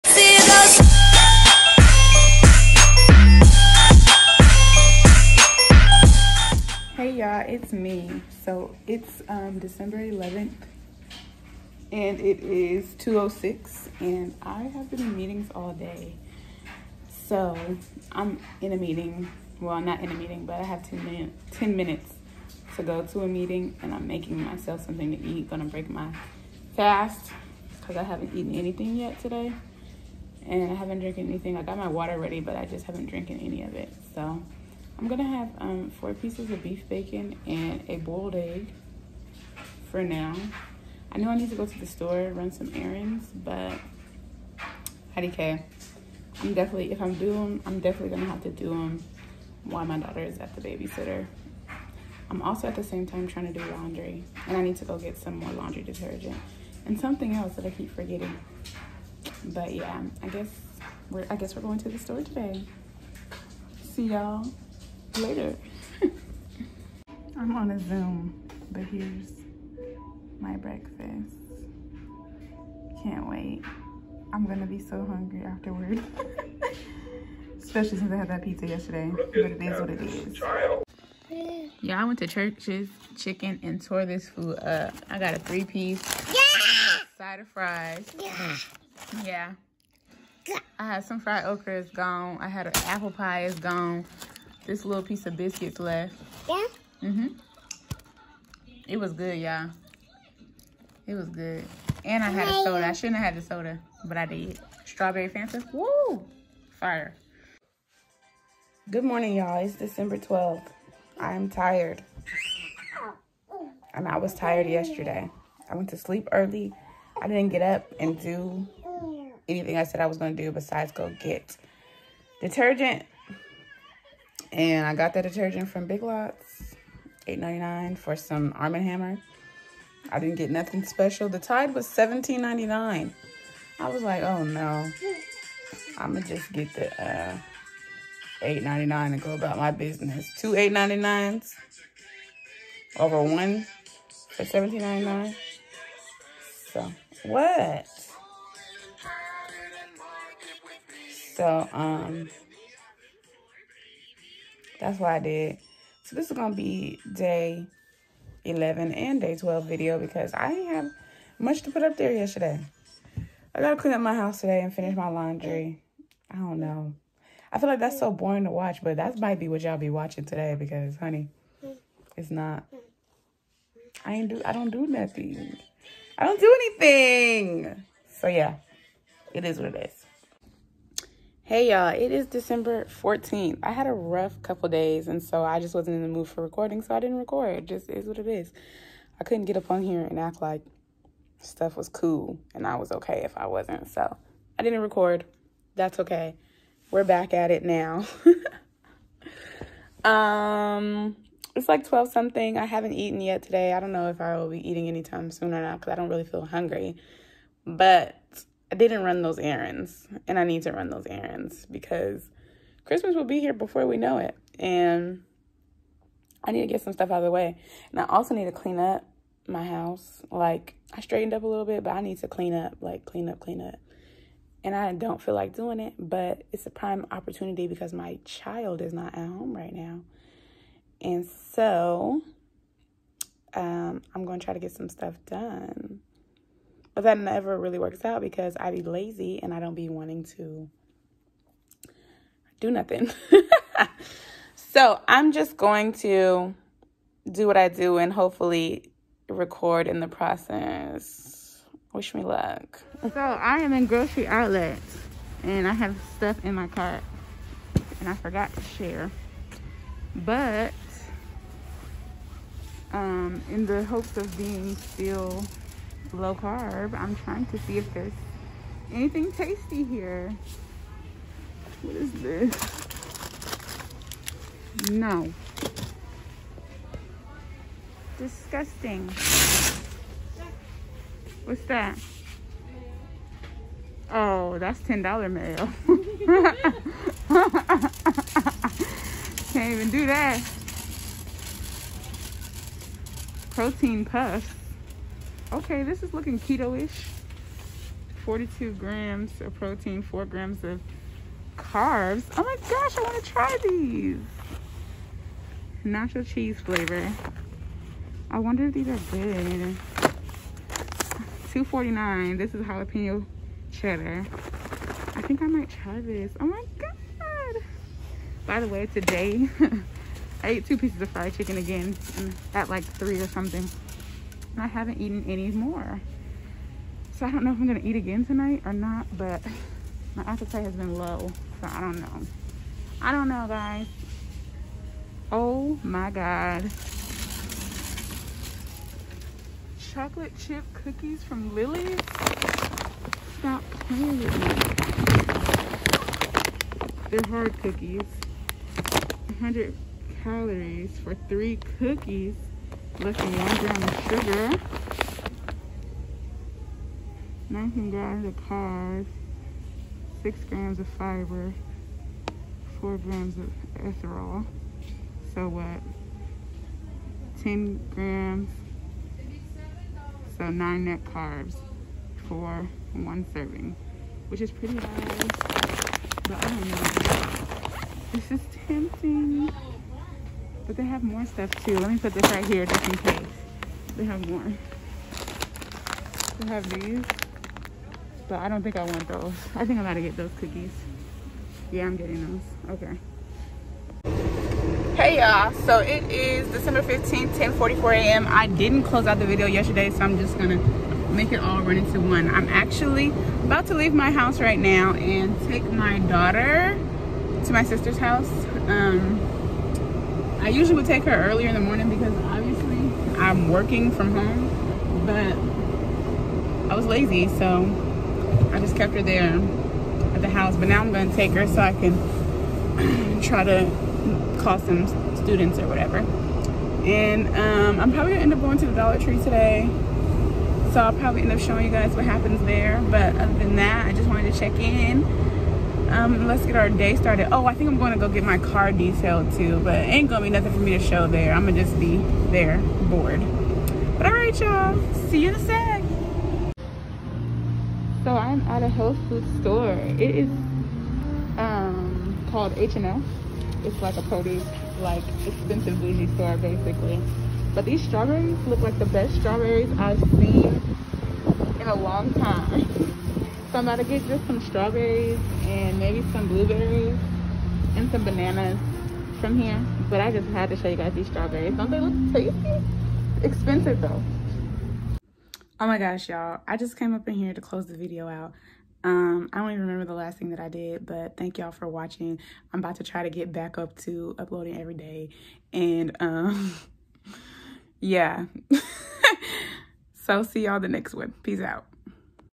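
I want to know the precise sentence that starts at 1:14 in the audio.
I'm gonna be so hungry afterward.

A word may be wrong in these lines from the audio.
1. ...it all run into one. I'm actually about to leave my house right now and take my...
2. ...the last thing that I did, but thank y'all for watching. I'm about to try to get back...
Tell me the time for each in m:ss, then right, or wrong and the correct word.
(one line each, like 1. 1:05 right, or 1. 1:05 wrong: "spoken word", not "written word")
1. 6:41 right
2. 7:59 right.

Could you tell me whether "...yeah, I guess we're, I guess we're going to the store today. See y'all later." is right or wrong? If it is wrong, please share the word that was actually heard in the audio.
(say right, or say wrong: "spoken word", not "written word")
right.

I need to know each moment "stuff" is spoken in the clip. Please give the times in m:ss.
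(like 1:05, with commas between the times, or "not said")
3:11, 3:36, 3:54, 4:16, 6:21.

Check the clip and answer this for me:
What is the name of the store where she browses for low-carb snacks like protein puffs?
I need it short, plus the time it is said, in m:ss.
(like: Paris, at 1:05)
Grocery Outlet, at 4:13.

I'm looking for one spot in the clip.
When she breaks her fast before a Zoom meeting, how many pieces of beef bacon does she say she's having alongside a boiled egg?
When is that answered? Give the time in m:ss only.
0:35.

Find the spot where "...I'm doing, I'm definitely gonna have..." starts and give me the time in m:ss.
0:47.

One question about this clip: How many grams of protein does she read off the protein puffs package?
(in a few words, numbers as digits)
42.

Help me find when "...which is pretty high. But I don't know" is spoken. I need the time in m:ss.
6:14.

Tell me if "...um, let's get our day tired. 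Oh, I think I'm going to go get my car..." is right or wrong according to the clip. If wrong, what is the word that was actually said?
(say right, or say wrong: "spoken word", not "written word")
wrong: "started", not "tired".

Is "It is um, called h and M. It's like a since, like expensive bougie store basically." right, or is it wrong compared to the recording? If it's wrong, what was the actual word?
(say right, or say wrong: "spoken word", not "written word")
wrong: "produce", not "since".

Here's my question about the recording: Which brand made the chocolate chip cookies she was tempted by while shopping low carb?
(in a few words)
Lily's.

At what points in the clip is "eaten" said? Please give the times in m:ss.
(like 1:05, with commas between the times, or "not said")
0:28, 3:22, 5:24.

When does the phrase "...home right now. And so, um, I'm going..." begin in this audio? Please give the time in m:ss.
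3:49.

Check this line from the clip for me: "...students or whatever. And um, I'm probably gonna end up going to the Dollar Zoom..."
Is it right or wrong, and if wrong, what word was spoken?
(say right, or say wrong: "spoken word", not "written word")
wrong: "Tree", not "Zoom".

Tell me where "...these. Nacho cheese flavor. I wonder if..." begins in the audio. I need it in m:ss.
5:03.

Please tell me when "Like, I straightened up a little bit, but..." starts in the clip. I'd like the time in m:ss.
3:40.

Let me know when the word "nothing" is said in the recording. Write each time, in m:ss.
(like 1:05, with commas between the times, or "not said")
2:10, 2:54, 4:02, 7:20.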